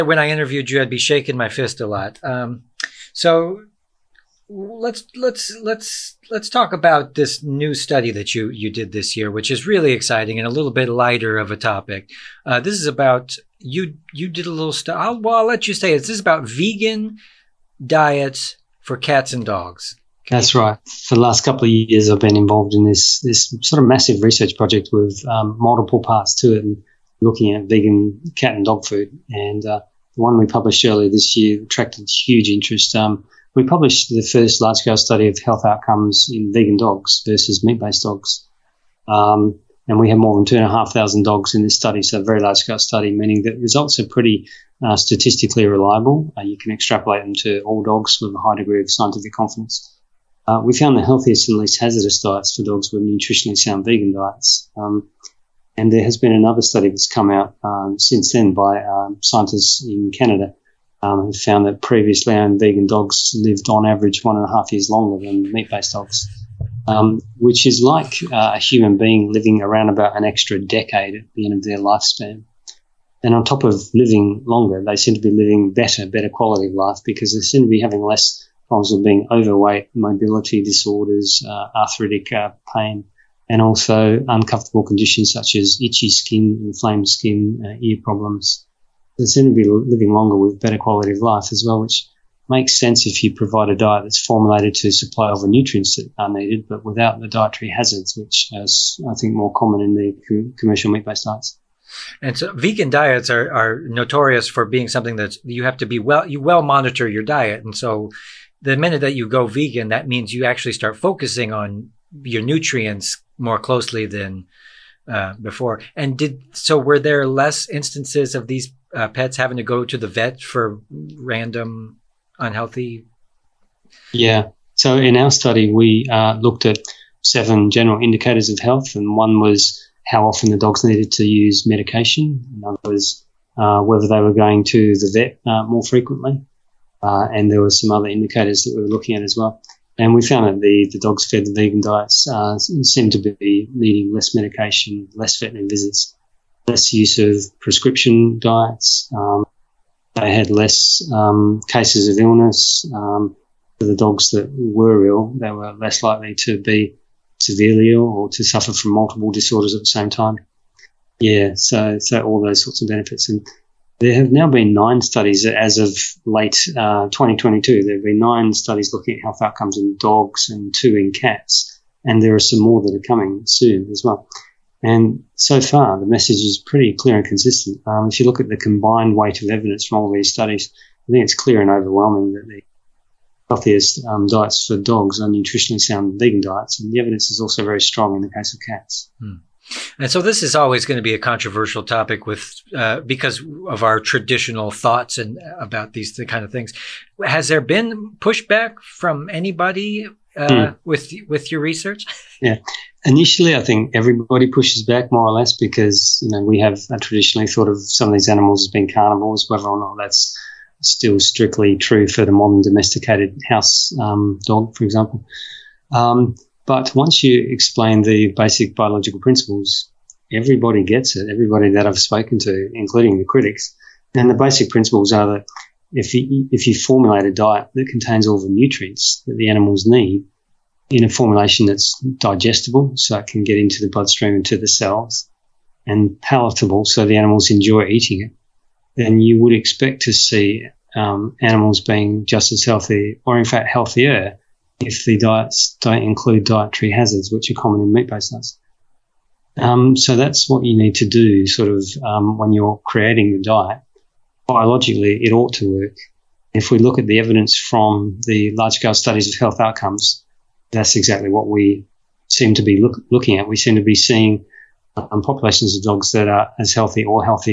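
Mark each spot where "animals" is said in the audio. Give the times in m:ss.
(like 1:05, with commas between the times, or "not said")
3:28, 3:49, 3:57, 4:01.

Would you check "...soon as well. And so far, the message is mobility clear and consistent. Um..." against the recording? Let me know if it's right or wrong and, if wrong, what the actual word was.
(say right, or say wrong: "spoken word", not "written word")
wrong: "pretty", not "mobility".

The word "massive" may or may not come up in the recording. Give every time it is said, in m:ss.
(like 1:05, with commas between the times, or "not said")
0:23.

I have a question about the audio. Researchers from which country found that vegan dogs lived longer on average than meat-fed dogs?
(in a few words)
Canada.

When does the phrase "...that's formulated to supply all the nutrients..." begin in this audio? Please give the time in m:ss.
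1:34.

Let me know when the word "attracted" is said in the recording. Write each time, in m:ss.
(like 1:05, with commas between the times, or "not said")
0:31.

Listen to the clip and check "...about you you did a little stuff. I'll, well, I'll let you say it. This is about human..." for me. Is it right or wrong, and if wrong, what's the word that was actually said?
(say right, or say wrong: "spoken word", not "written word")
wrong: "vegan", not "human".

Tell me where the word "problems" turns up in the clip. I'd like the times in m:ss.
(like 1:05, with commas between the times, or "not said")
1:18, 1:28.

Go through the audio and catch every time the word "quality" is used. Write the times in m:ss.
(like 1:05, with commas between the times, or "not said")
1:16, 1:30.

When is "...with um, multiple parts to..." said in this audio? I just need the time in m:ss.
0:24.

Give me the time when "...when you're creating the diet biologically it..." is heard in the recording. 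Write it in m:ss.
4:12.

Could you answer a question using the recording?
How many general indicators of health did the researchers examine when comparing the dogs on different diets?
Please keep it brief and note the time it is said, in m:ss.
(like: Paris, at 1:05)
7, at 2:07.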